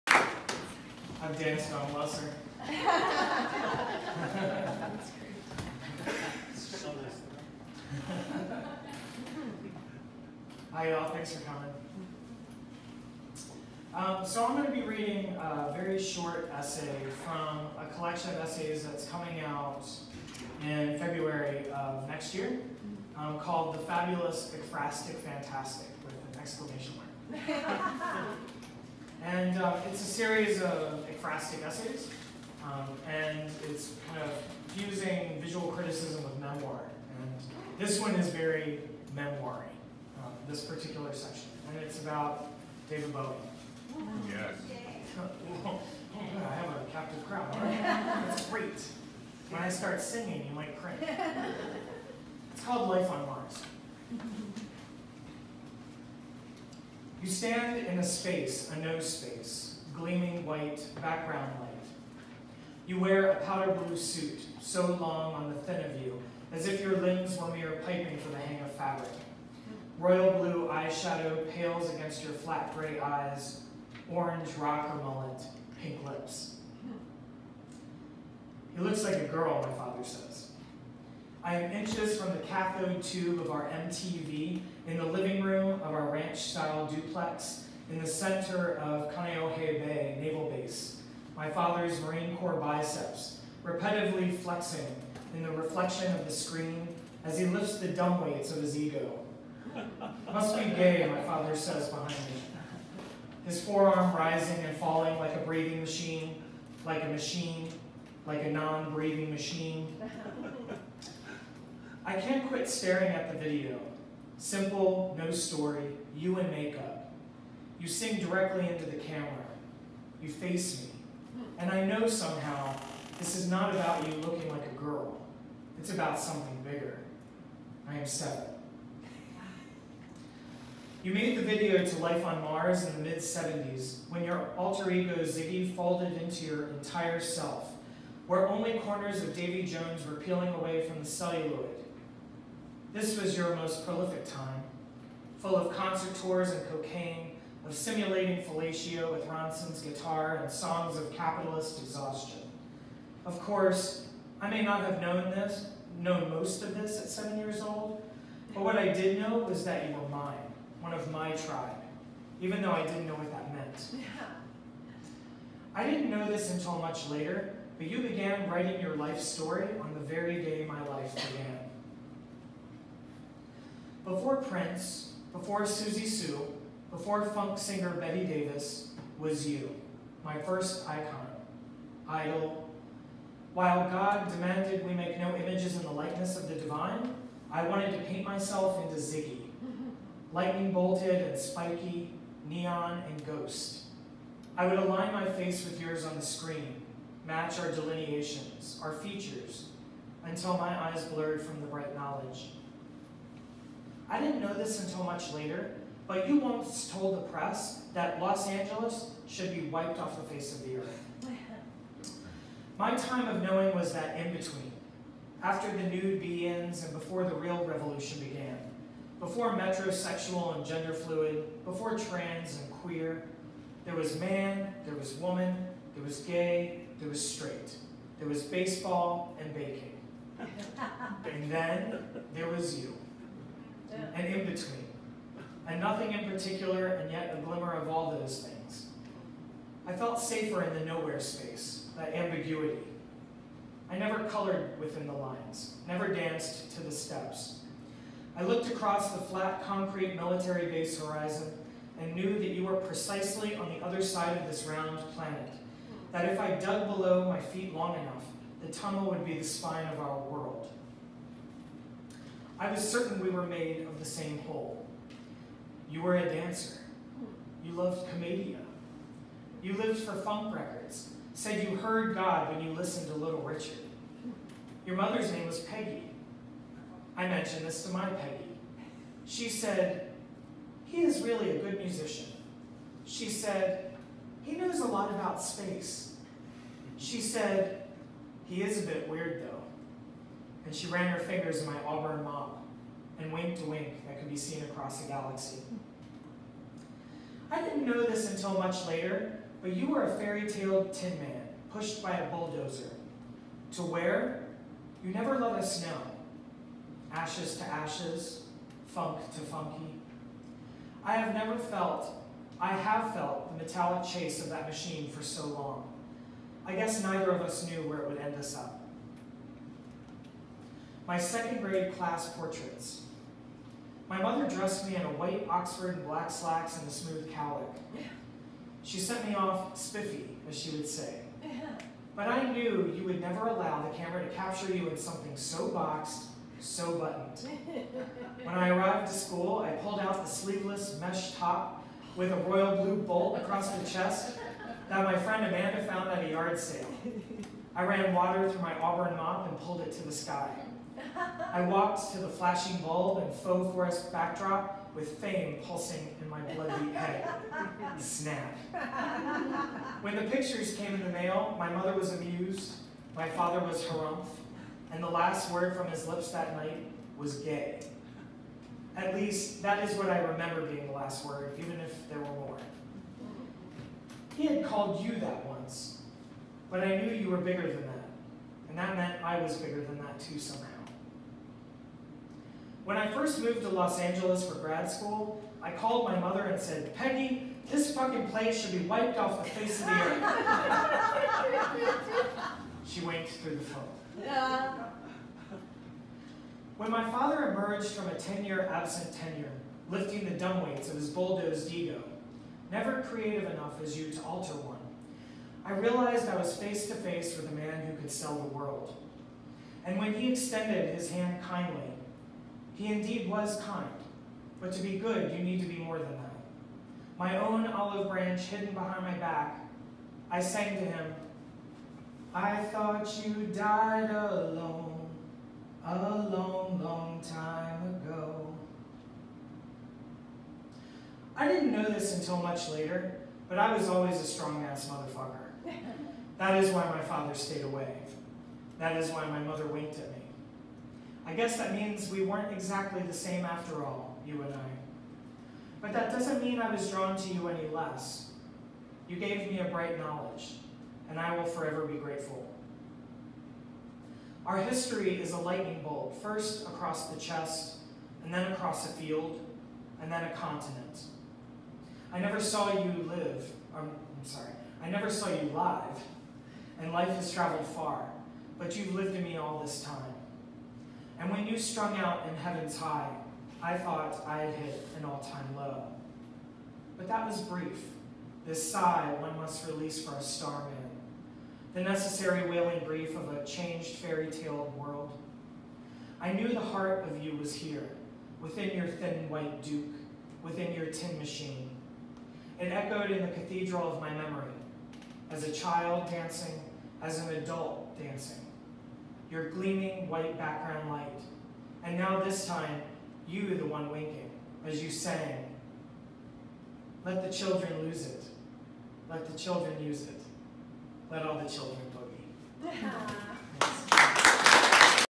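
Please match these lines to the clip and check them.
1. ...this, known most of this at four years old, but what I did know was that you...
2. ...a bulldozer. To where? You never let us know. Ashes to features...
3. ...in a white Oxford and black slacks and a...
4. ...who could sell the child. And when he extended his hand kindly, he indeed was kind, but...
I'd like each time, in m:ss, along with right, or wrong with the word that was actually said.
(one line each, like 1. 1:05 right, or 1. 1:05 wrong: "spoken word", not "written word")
1. 2:35 wrong: "seven", not "four"
2. 5:02 wrong: "ashes", not "features"
3. 5:24 right
4. 6:47 wrong: "world", not "child".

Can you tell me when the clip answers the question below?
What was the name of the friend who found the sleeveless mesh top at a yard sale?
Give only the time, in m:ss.
5:45.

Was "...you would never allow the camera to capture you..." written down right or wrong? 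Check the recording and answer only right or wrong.
right.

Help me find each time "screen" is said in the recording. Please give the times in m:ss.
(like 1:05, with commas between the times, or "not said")
1:36, 3:16.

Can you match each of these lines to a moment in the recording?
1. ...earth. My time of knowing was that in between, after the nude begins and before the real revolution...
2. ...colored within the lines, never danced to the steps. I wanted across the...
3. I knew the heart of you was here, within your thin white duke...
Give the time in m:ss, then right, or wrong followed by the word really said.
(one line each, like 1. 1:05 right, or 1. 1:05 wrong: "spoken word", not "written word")
1. 3:30 right
2. 4:04 wrong: "looked", not "wanted"
3. 8:06 right.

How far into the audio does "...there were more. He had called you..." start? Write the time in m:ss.
6:12.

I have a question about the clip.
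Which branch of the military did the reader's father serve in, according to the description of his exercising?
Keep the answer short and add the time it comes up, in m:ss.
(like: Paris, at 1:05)
Marine Corps, at 1:31.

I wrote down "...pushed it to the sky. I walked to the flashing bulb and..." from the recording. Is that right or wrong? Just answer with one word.
wrong.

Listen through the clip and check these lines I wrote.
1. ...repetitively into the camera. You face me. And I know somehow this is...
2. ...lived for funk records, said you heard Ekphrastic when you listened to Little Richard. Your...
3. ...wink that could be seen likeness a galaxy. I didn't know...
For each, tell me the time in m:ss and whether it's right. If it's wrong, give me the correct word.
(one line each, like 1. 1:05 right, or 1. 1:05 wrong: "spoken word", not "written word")
1. 1:58 wrong: "directly", not "repetitively"
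2. 4:29 wrong: "God", not "Ekphrastic"
3. 4:53 wrong: "across", not "likeness".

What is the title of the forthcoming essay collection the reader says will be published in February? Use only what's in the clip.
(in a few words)
The Fabulous Ekphrastic Fantastic.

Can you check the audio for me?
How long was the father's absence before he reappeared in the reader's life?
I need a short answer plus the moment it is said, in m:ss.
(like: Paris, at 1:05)
10 years, at 6:38.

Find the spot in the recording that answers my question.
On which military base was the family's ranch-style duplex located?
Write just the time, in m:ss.
1:29.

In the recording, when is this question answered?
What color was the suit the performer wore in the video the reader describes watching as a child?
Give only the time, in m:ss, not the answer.
1:03.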